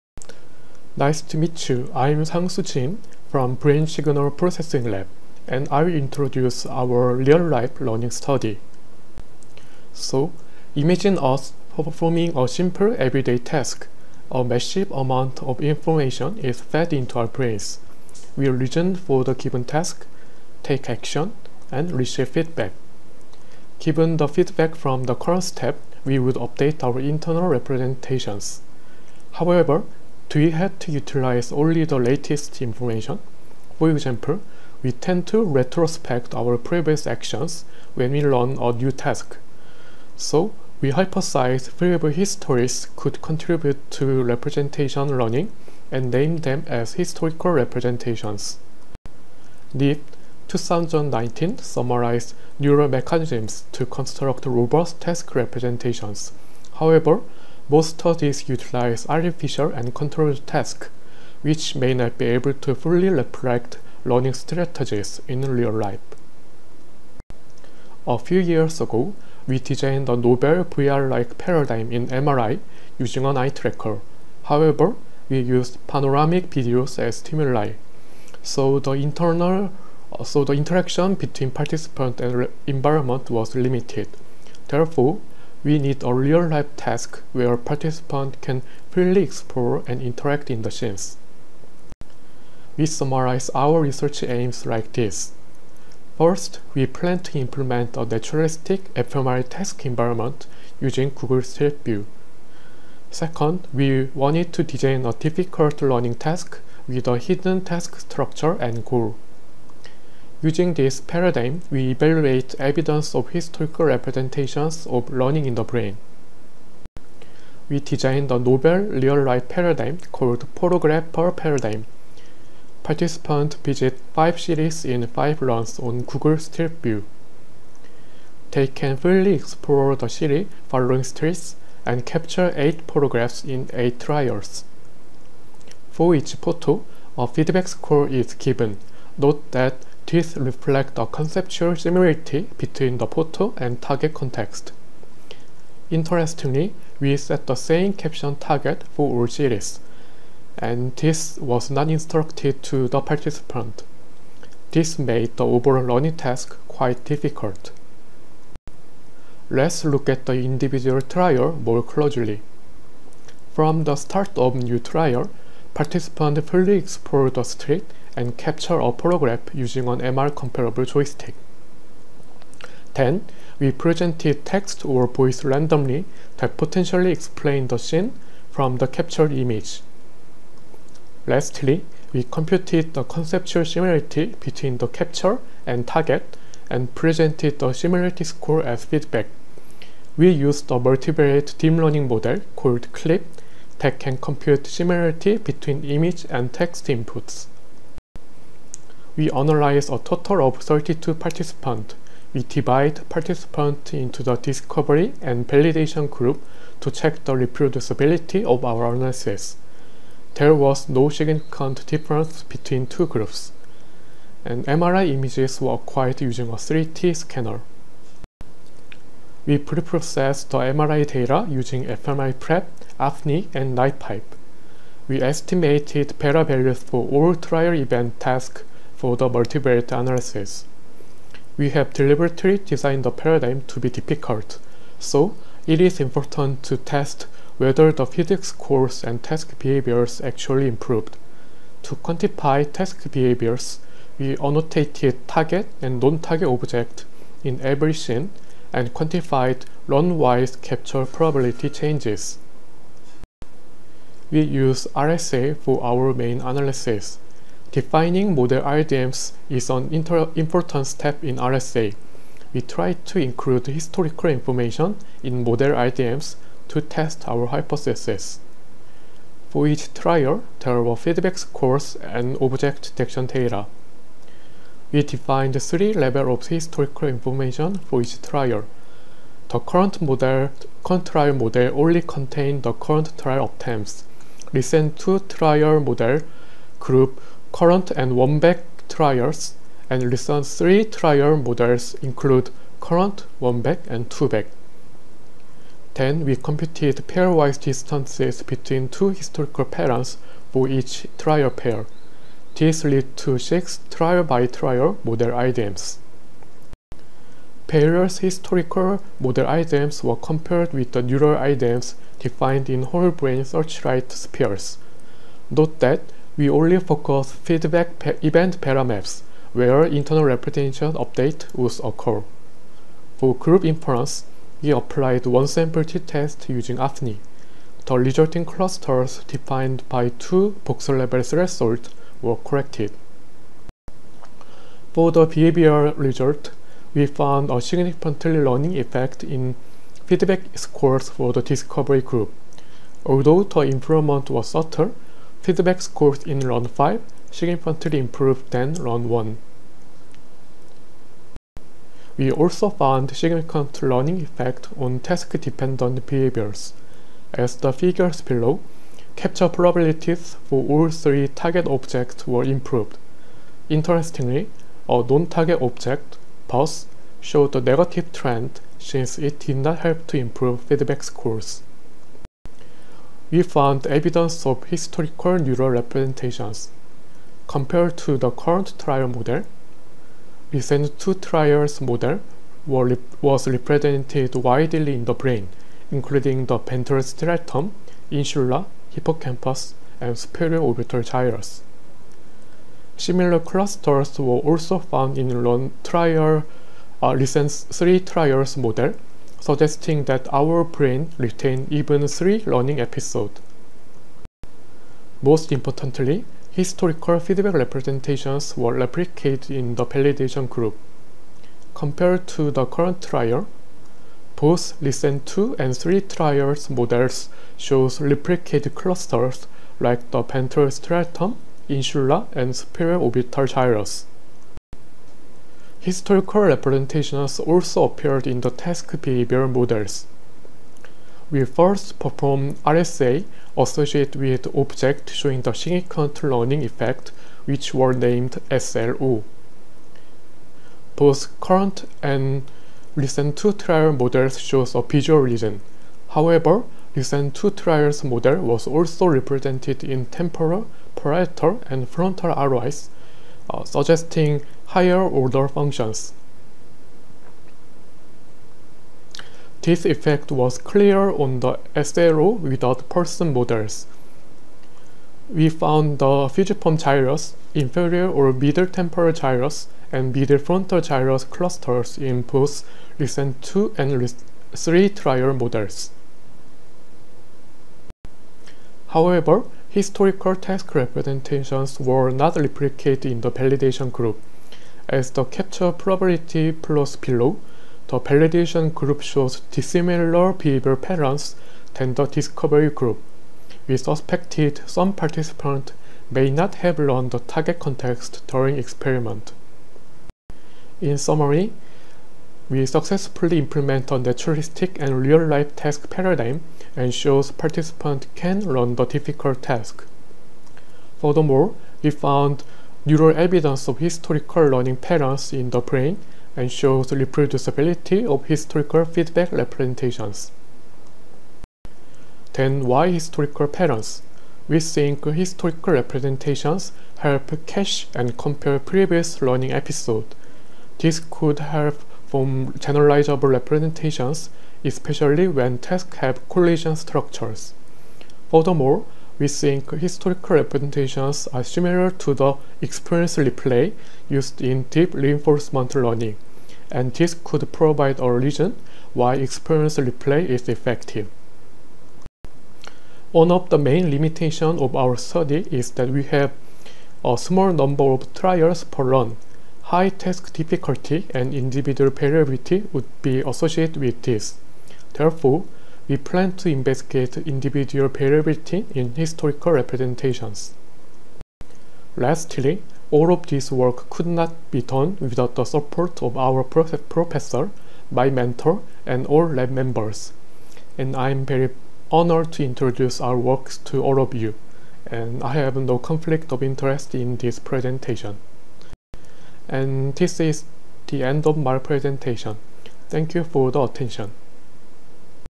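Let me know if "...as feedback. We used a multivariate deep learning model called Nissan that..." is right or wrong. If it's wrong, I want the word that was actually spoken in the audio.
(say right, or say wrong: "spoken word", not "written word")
wrong: "CLIP", not "Nissan".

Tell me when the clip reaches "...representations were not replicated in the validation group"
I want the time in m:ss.
8:00.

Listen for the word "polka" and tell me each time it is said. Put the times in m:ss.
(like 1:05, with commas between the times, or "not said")
not said.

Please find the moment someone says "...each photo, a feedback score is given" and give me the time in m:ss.
2:16.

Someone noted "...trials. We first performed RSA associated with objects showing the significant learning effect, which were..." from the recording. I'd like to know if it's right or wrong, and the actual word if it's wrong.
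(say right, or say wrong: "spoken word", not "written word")
wrong: "models", not "trials".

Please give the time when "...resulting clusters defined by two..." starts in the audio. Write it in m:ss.
5:27.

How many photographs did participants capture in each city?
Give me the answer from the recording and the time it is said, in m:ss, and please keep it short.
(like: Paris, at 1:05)
8, at 2:12.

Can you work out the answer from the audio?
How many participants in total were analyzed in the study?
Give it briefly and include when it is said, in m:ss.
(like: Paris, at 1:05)
32, at 3:20.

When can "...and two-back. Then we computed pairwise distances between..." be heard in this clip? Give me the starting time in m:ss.
4:53.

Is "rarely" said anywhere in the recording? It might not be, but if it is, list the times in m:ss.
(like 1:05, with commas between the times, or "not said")
not said.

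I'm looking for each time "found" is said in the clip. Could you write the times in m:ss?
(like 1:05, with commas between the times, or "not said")
5:37, 5:52, 6:13, 6:34, 7:45, 8:31.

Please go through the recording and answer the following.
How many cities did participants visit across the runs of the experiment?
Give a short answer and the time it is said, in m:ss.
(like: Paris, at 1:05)
5, at 2:04.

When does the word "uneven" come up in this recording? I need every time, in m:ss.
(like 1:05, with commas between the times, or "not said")
not said.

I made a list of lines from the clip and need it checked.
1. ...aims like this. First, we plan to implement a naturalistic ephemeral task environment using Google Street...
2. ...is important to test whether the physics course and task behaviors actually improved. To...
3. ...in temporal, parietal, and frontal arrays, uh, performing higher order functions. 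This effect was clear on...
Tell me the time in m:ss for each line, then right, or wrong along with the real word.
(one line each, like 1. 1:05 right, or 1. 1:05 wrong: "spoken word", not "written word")
1. 1:34 right
2. 3:55 right
3. 7:29 wrong: "suggesting", not "performing".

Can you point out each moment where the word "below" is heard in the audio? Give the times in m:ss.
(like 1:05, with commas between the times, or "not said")
5:58, 8:06.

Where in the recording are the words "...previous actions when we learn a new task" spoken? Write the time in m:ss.
0:36.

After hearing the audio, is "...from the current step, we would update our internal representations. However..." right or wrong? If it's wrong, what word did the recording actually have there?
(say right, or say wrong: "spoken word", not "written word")
right.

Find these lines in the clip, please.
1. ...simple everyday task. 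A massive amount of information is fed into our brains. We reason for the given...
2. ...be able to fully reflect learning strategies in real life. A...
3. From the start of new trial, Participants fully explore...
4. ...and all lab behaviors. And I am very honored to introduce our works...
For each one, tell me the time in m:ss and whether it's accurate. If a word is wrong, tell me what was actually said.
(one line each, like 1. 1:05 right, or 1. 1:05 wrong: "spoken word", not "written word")
1. 0:12 right
2. 1:02 right
3. 2:43 right
4. 9:38 wrong: "members", not "behaviors".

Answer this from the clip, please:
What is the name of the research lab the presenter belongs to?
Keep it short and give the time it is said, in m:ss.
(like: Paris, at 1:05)
Brain Signal Processing Lab, at 0:03.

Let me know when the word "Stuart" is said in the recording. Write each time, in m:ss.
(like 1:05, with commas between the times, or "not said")
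not said.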